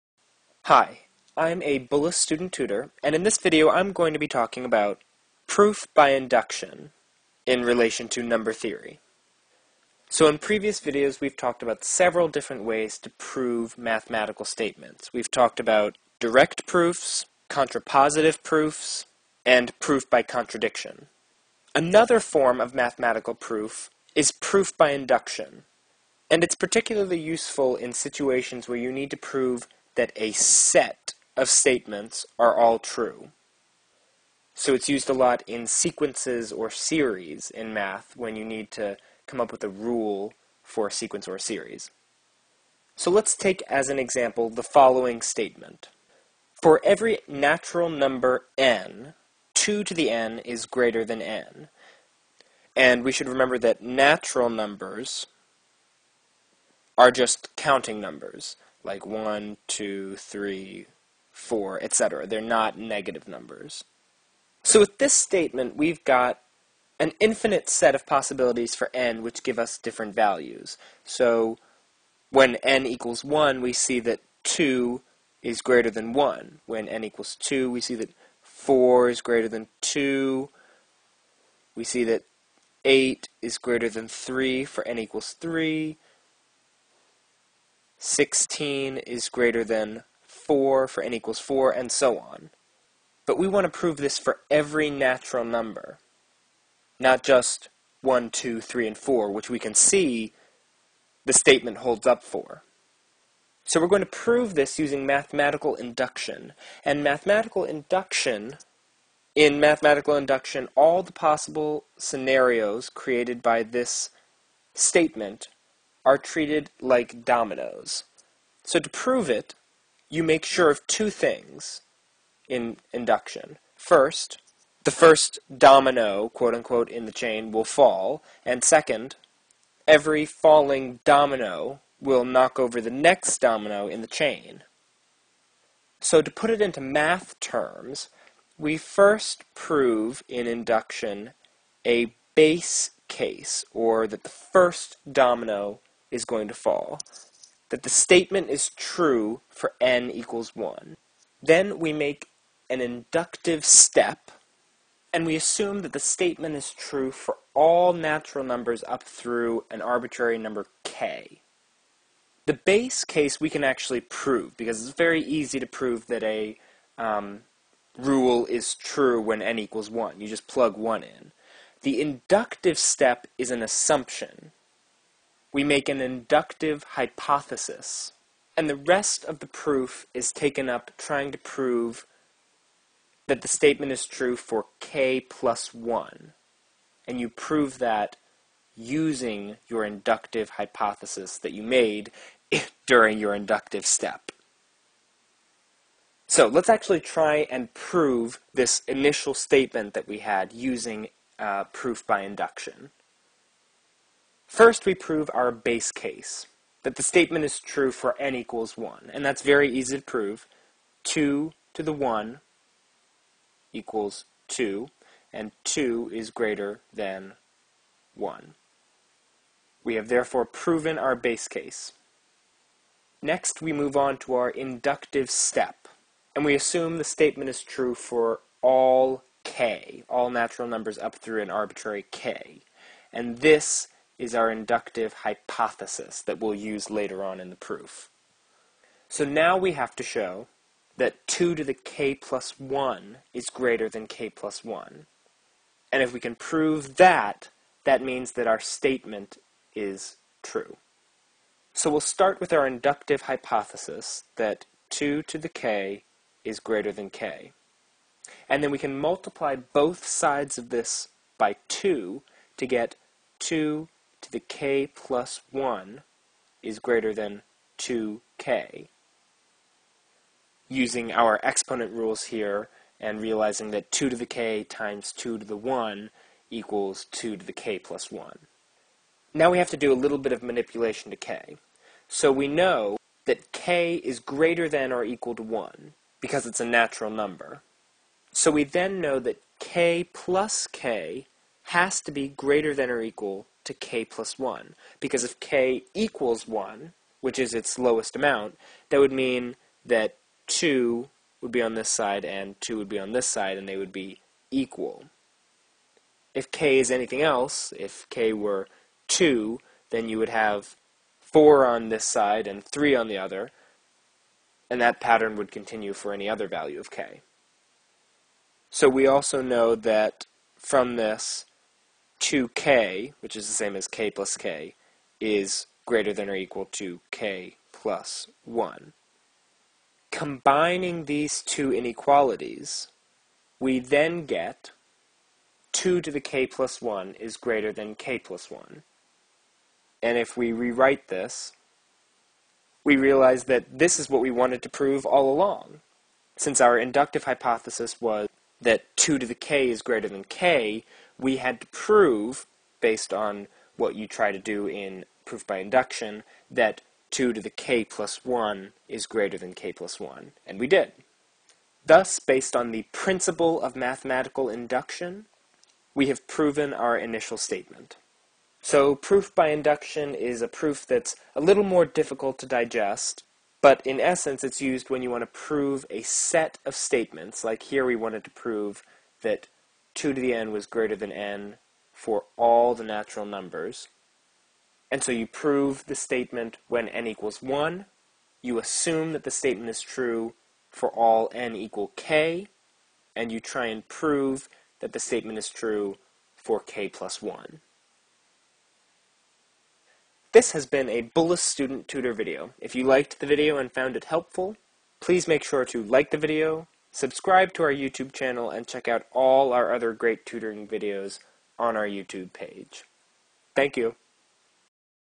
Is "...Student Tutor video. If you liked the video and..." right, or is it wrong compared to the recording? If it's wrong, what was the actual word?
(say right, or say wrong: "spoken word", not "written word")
right.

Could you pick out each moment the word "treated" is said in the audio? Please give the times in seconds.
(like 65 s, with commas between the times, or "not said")
116 s.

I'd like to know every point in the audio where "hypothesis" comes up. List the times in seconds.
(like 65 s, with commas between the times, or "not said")
176 s, 190 s, 235 s, 253 s, 347 s.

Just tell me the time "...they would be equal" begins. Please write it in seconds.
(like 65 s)
303 s.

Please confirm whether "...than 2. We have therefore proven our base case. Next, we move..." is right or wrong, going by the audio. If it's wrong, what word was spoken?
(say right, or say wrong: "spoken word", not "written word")
wrong: "1", not "2".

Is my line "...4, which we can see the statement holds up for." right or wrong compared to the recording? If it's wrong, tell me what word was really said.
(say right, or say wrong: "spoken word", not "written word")
right.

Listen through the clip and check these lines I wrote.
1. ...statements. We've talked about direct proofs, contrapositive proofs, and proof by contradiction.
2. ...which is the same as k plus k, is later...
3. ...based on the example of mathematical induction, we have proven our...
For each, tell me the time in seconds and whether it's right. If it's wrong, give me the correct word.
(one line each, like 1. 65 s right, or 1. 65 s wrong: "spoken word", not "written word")
1. 14 s right
2. 323 s wrong: "greater", not "later"
3. 362 s wrong: "principle", not "example".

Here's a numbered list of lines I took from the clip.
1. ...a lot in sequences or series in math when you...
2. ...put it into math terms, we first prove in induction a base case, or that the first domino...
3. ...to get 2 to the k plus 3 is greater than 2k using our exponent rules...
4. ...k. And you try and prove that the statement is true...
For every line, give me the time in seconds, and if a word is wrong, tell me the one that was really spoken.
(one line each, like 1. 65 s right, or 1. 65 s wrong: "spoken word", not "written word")
1. 35 s right
2. 136 s right
3. 262 s wrong: "1", not "3"
4. 391 s right.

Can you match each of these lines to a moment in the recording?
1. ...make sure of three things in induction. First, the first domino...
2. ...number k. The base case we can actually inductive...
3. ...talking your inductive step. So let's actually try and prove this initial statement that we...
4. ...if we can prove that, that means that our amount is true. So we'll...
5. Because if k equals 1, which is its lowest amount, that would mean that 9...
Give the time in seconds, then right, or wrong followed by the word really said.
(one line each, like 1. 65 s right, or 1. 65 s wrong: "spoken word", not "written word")
1. 120 s wrong: "two", not "three"
2. 160 s wrong: "prove", not "inductive"
3. 192 s wrong: "during", not "talking"
4. 246 s wrong: "statement", not "amount"
5. 294 s wrong: "2", not "9".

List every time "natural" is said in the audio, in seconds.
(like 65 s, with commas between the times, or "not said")
47 s, 53 s, 94 s, 157 s, 230 s, 286 s, 382 s.